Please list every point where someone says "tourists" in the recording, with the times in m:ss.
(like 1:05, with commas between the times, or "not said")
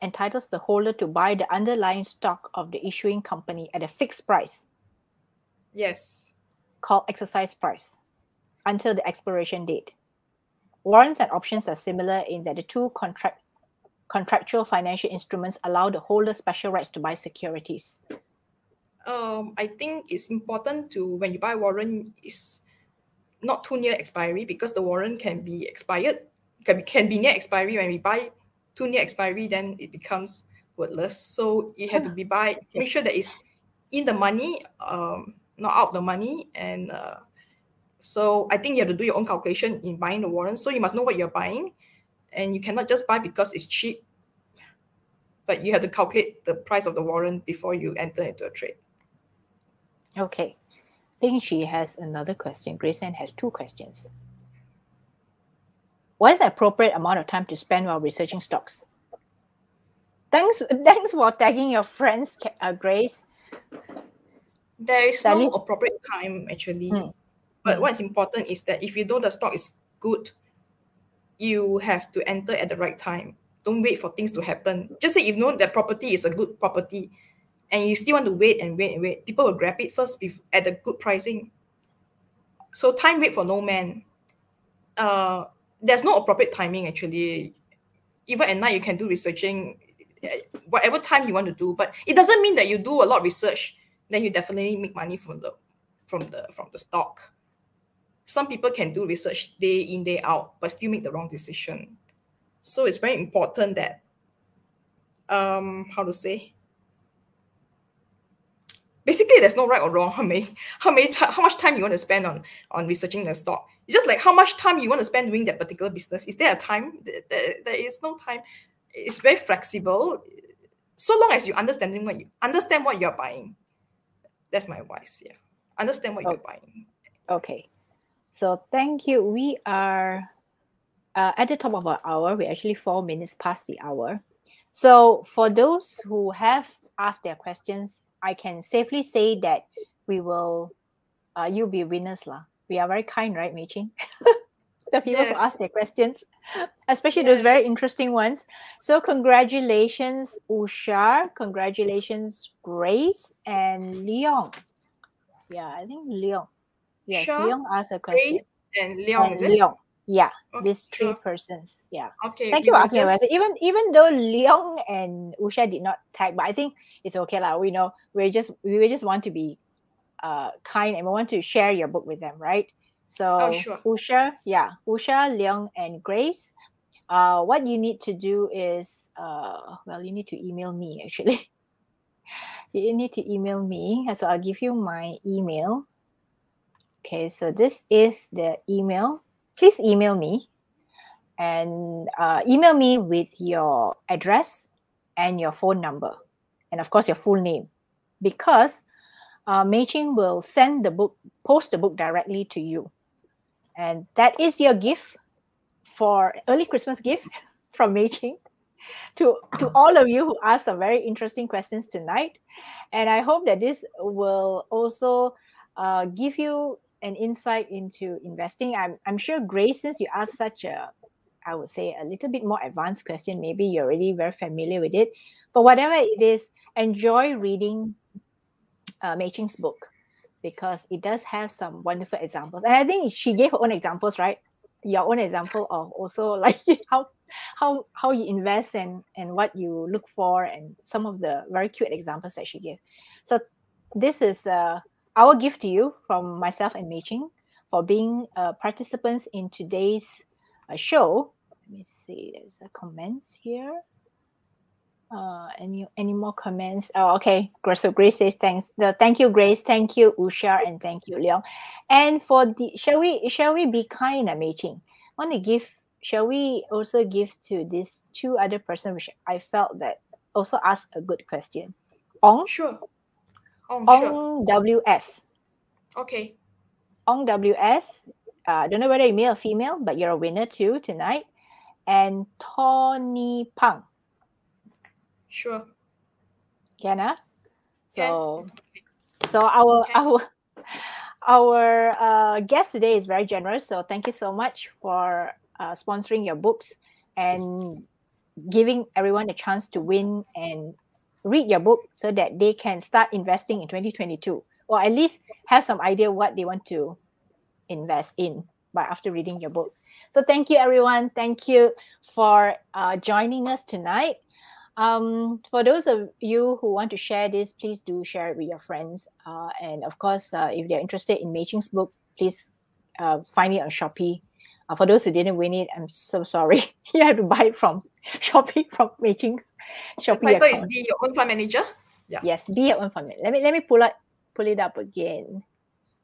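not said.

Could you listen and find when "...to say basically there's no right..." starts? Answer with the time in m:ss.
1:46.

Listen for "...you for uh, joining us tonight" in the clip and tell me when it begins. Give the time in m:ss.
5:11.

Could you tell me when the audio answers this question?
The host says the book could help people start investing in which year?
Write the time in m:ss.
5:03.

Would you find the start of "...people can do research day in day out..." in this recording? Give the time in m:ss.
1:38.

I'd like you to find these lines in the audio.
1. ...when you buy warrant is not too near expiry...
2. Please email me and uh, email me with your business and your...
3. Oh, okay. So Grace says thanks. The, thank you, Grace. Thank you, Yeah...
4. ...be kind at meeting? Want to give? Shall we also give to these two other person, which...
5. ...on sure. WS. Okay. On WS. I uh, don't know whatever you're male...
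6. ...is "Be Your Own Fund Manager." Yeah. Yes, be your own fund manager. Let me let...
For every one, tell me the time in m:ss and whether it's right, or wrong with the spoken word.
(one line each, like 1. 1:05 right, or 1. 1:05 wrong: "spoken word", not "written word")
1. 0:21 right
2. 3:09 wrong: "address", not "business"
3. 4:16 wrong: "Usha", not "Yeah"
4. 4:23 right
5. 4:33 wrong: "whether", not "whatever"
6. 5:30 right.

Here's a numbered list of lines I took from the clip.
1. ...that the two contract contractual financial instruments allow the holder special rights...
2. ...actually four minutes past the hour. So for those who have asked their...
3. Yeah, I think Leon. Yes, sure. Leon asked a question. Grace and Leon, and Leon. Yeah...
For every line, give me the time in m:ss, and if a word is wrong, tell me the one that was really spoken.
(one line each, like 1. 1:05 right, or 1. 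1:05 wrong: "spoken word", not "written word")
1. 0:12 right
2. 2:12 right
3. 2:35 right.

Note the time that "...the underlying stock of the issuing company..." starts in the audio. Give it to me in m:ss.
0:01.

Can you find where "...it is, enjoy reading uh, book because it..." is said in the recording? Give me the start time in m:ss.
3:45.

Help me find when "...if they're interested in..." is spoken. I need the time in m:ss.
5:20.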